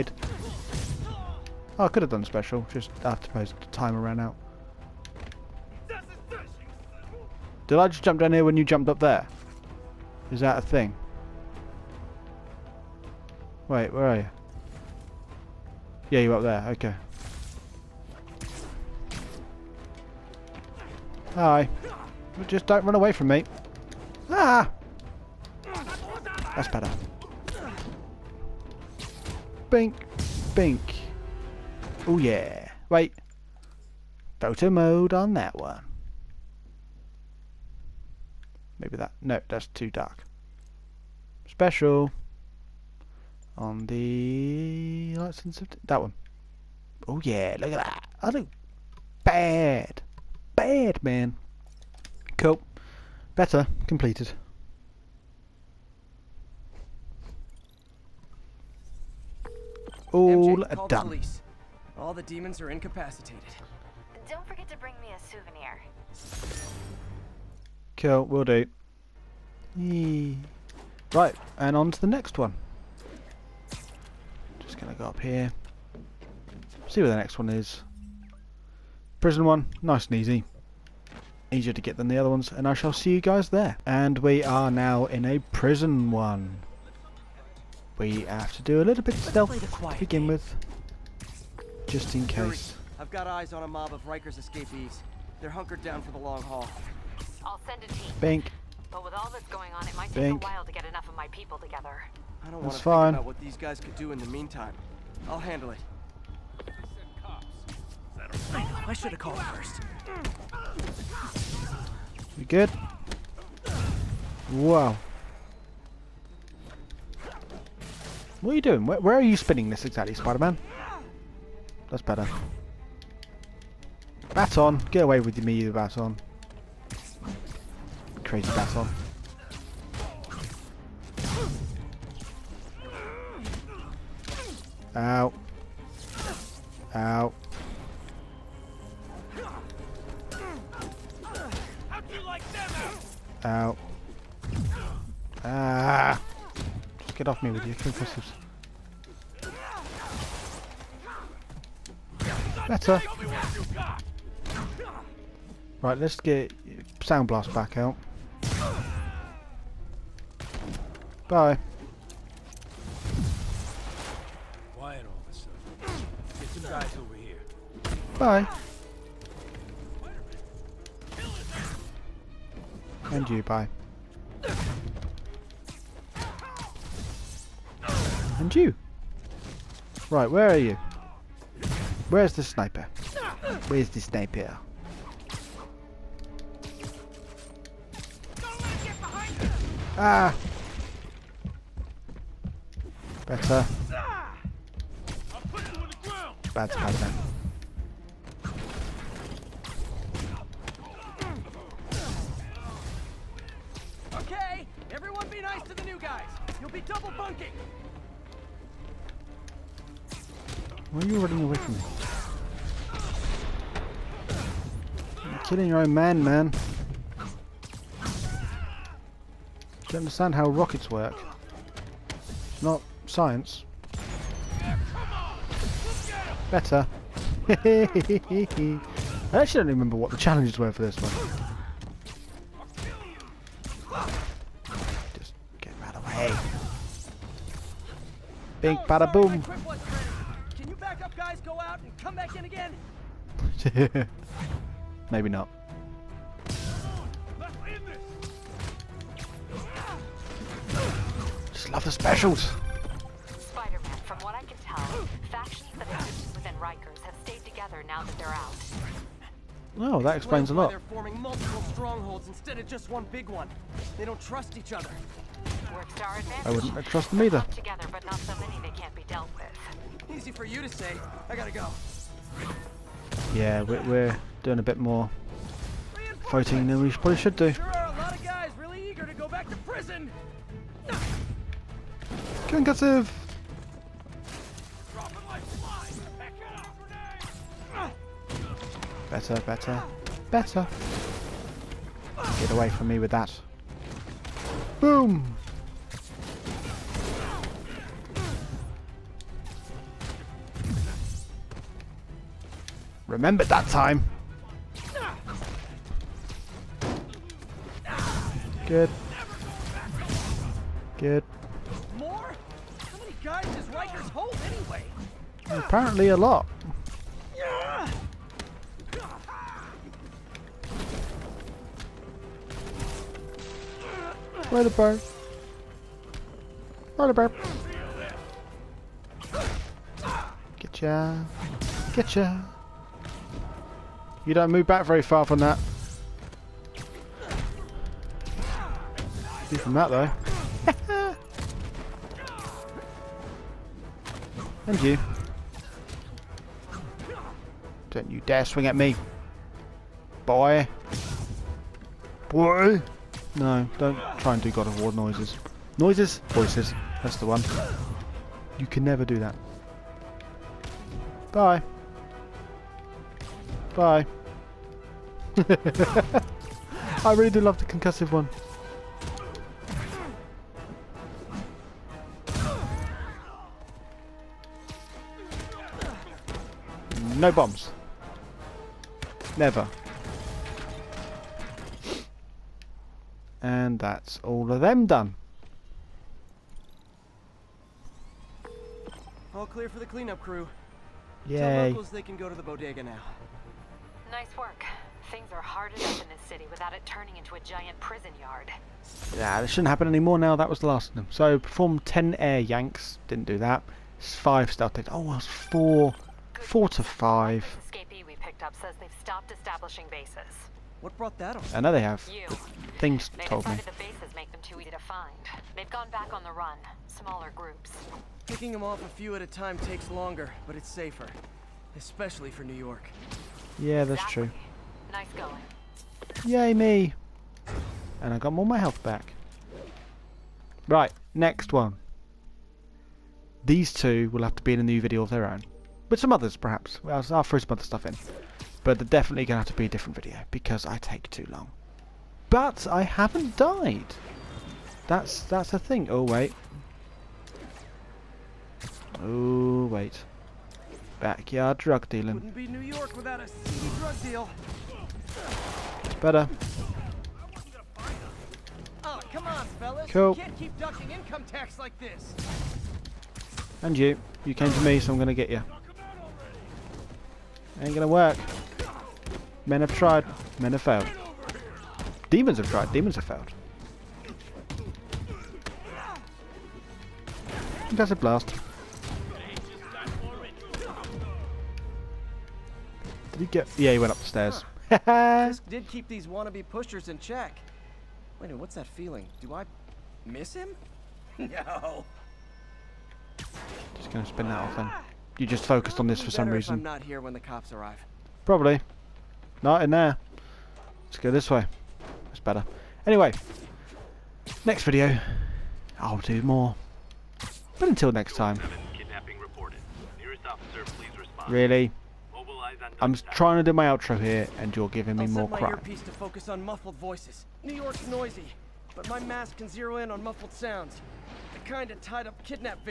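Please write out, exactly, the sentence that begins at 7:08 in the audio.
And I got more my health back.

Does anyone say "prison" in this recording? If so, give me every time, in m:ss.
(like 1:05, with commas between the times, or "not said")
1:19, 1:25, 6:37.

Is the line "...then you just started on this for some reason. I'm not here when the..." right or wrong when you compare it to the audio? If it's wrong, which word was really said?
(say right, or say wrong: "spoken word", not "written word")
wrong: "focused", not "started".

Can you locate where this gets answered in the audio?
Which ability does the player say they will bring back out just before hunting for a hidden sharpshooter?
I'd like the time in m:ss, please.
2:37.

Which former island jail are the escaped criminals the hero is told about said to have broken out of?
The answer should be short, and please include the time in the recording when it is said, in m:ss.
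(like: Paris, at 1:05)
Rikers, at 1:34.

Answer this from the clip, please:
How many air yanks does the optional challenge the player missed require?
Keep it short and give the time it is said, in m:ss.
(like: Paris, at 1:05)
10, at 6:41.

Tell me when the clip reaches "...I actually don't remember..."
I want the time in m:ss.
3:47.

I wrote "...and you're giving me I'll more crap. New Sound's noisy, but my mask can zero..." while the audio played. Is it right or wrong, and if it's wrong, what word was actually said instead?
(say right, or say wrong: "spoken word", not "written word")
wrong: "York", not "Sound".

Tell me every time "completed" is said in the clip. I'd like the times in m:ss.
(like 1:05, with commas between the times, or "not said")
0:53.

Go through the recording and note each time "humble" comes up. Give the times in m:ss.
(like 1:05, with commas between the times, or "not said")
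not said.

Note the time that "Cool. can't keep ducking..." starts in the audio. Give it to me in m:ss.
7:39.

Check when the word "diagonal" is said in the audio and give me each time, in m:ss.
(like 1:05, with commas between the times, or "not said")
not said.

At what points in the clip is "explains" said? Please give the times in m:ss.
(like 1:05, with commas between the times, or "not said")
4:20.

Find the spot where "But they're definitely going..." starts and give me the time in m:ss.
7:18.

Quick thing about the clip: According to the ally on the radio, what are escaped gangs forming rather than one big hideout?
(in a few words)
Multiple strongholds.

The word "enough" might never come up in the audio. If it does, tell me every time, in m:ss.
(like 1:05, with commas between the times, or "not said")
1:40, 6:35.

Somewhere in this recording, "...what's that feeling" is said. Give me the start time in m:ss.
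8:08.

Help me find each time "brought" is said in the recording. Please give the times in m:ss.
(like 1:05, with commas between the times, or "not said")
6:50.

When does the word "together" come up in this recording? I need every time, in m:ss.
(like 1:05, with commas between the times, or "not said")
1:41, 4:17, 4:27.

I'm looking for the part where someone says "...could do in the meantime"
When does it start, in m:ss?
1:43.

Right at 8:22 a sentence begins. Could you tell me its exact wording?
Anyway, next video, I'll do more.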